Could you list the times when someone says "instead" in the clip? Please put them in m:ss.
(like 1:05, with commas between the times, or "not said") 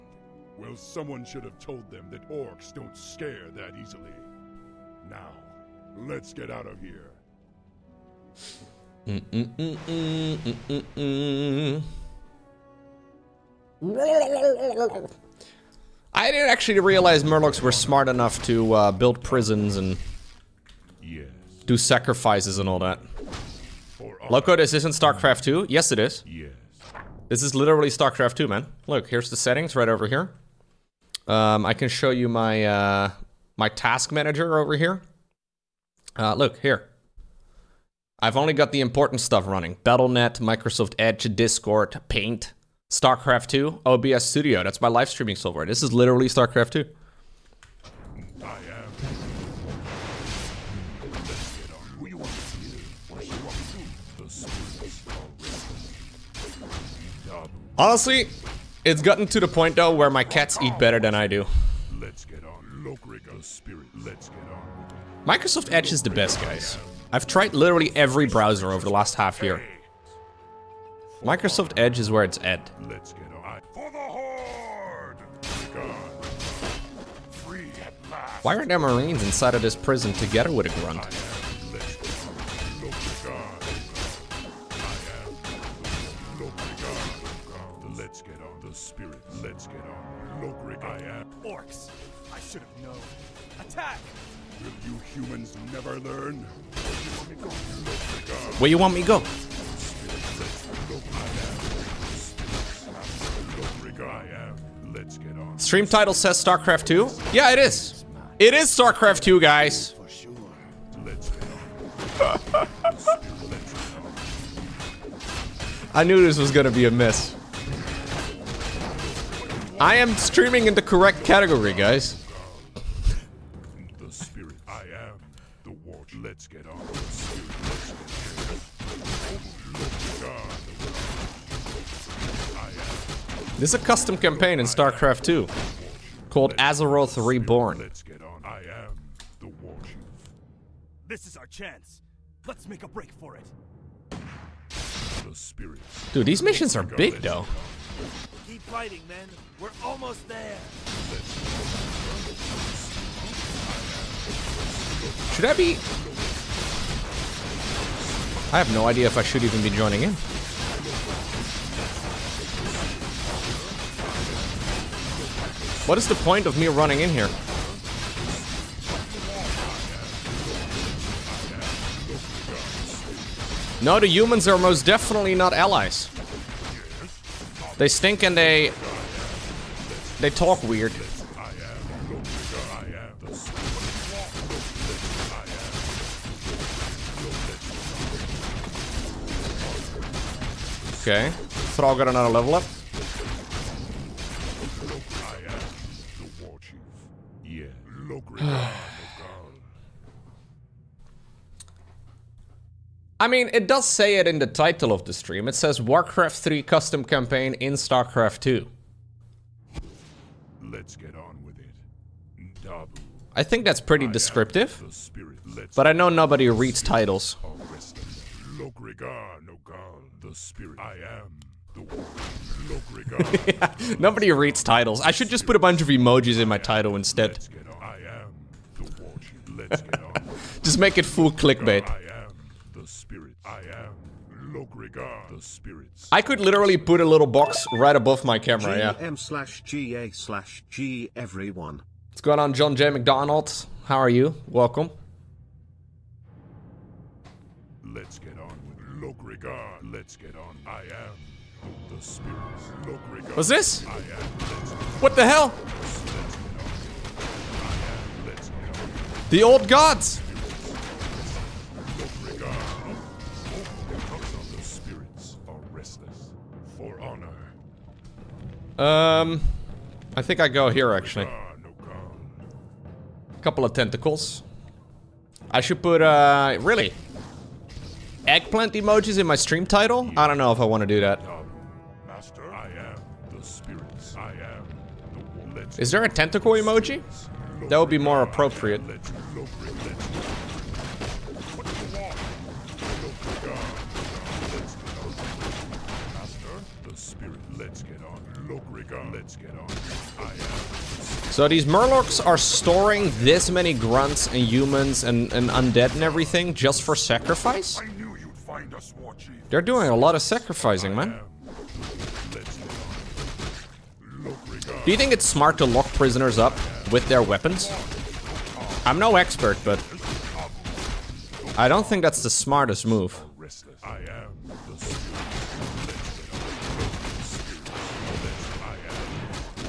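3:46.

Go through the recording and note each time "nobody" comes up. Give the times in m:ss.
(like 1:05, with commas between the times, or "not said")
3:36, 3:43.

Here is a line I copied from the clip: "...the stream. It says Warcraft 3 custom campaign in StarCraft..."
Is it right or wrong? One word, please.
right.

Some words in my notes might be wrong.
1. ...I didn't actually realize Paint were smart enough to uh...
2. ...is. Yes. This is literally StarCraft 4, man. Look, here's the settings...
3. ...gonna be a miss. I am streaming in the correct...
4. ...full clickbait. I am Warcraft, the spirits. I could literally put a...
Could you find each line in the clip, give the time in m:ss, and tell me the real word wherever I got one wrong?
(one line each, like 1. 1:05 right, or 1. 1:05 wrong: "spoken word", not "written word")
1. 0:16 wrong: "Murlocs", not "Paint"
2. 0:25 wrong: "2", not "4"
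3. 1:56 right
4. 3:51 wrong: "Logrigar", not "Warcraft".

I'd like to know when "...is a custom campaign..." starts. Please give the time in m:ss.
2:13.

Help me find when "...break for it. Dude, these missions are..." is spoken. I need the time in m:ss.
2:22.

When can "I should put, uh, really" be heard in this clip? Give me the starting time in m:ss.
4:35.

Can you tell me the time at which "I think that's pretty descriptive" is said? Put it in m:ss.
3:33.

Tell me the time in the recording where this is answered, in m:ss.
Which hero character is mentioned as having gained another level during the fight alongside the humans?
3:11.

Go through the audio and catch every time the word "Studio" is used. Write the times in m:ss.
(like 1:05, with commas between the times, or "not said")
0:44.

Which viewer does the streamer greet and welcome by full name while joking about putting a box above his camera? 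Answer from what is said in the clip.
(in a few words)
John J. McDonald.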